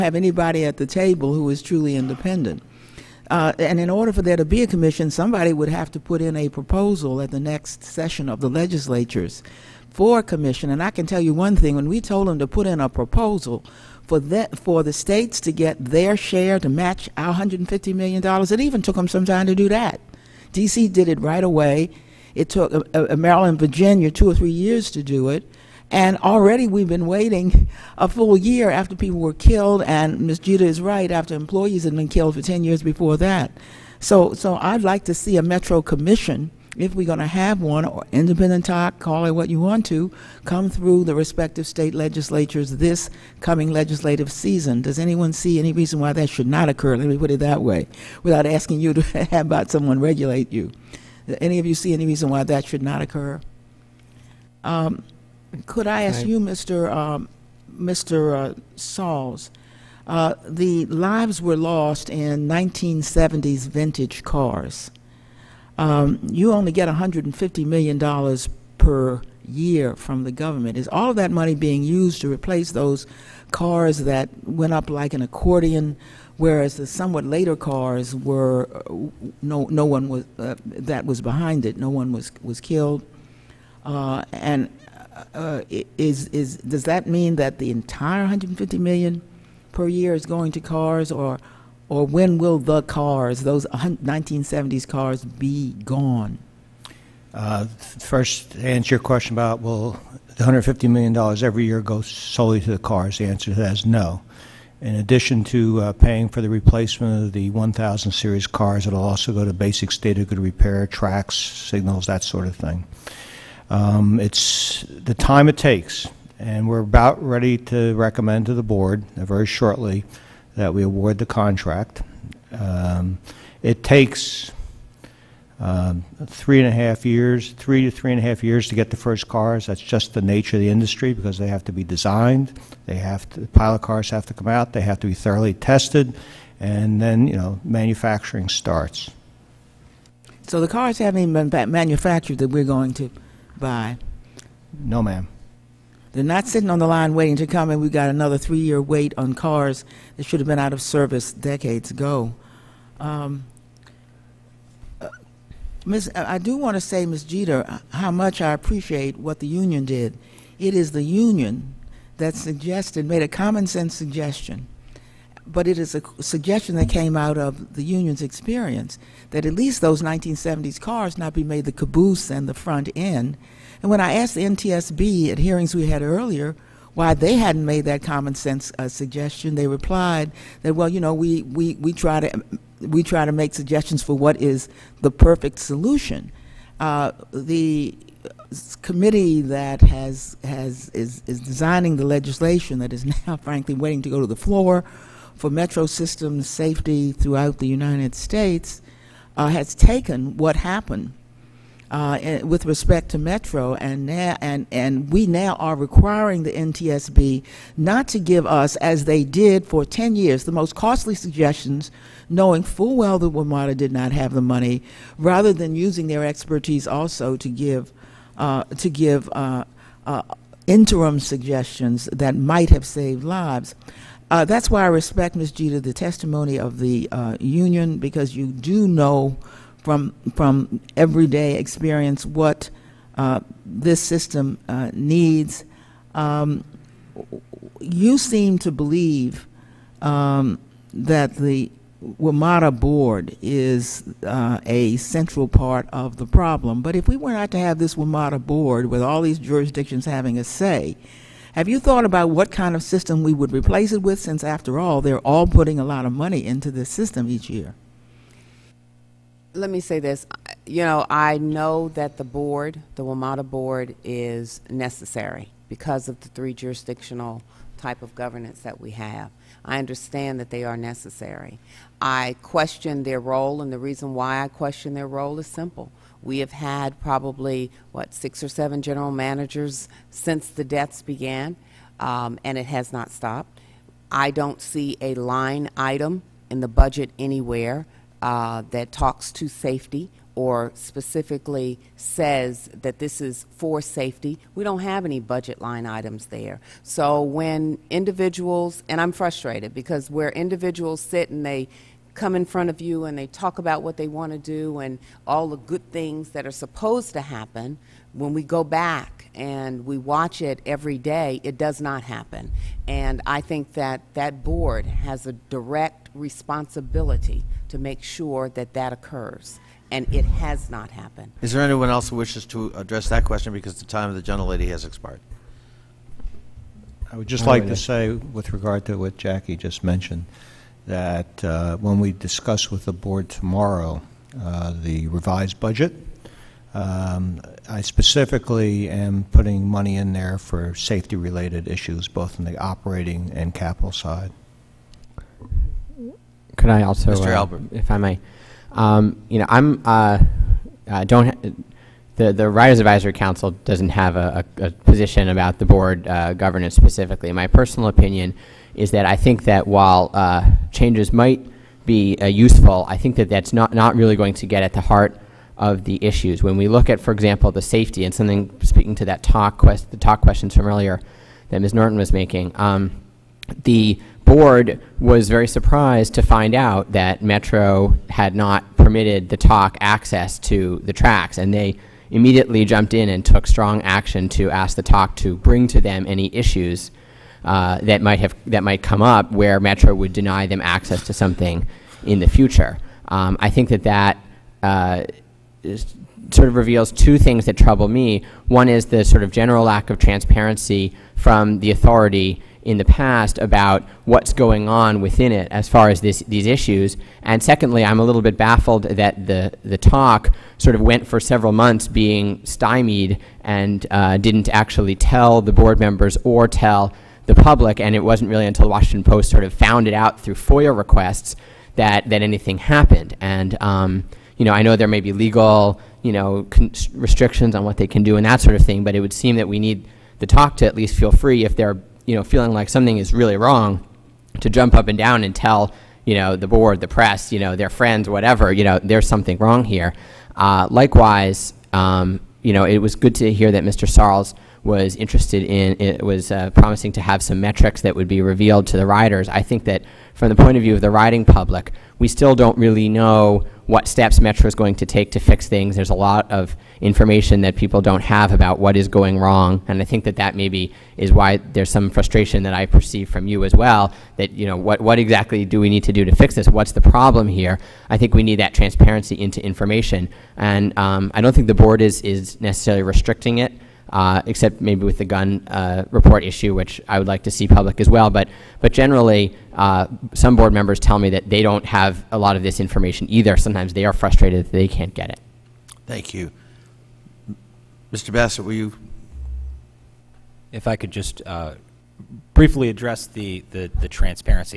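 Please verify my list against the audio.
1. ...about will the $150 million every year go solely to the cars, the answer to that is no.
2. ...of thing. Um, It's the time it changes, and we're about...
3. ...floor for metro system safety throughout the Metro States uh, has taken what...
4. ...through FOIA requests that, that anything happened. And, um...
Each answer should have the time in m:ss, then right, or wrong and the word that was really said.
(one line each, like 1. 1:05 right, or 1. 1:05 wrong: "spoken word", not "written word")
1. 1:39 right
2. 1:52 wrong: "takes", not "changes"
3. 3:14 wrong: "United", not "Metro"
4. 7:00 right.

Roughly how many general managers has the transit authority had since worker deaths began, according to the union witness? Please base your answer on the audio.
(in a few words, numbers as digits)
six or seven.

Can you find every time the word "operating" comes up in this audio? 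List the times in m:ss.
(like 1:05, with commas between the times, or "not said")
5:42.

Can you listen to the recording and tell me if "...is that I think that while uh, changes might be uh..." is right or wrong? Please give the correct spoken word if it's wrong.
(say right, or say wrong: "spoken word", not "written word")
right.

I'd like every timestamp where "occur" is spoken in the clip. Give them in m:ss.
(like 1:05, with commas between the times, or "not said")
0:46, 0:53, 5:18.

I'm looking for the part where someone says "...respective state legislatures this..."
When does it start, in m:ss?
0:41.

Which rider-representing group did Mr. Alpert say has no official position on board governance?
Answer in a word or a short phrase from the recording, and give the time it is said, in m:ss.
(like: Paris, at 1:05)
Riders Advisory Council, at 5:52.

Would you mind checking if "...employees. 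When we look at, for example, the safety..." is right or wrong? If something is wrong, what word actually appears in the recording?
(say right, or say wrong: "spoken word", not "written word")
wrong: "issues", not "employees".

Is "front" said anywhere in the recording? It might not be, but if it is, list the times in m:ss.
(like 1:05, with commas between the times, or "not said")
2:52, 5:02.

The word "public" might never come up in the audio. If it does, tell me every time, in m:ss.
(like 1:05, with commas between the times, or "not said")
6:57, 7:31, 7:57.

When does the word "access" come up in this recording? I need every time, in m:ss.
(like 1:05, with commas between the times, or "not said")
6:19, 6:30.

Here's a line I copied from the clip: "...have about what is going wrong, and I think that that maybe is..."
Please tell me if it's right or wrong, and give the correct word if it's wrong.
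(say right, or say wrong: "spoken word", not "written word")
right.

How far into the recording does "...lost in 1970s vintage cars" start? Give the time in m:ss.
1:01.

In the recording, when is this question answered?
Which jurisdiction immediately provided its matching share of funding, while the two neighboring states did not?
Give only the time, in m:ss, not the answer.
0:20.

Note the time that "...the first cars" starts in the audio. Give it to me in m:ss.
2:08.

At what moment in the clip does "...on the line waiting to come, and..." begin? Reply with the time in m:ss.
2:26.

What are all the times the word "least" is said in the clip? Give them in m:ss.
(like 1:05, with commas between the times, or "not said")
2:49, 7:10.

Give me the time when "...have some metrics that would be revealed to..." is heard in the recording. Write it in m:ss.
7:27.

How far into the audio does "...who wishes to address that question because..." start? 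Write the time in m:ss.
5:22.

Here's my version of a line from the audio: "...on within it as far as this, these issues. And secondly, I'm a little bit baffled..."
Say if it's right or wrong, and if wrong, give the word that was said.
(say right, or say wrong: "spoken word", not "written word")
right.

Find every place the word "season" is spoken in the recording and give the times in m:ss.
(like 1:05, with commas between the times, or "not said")
0:44.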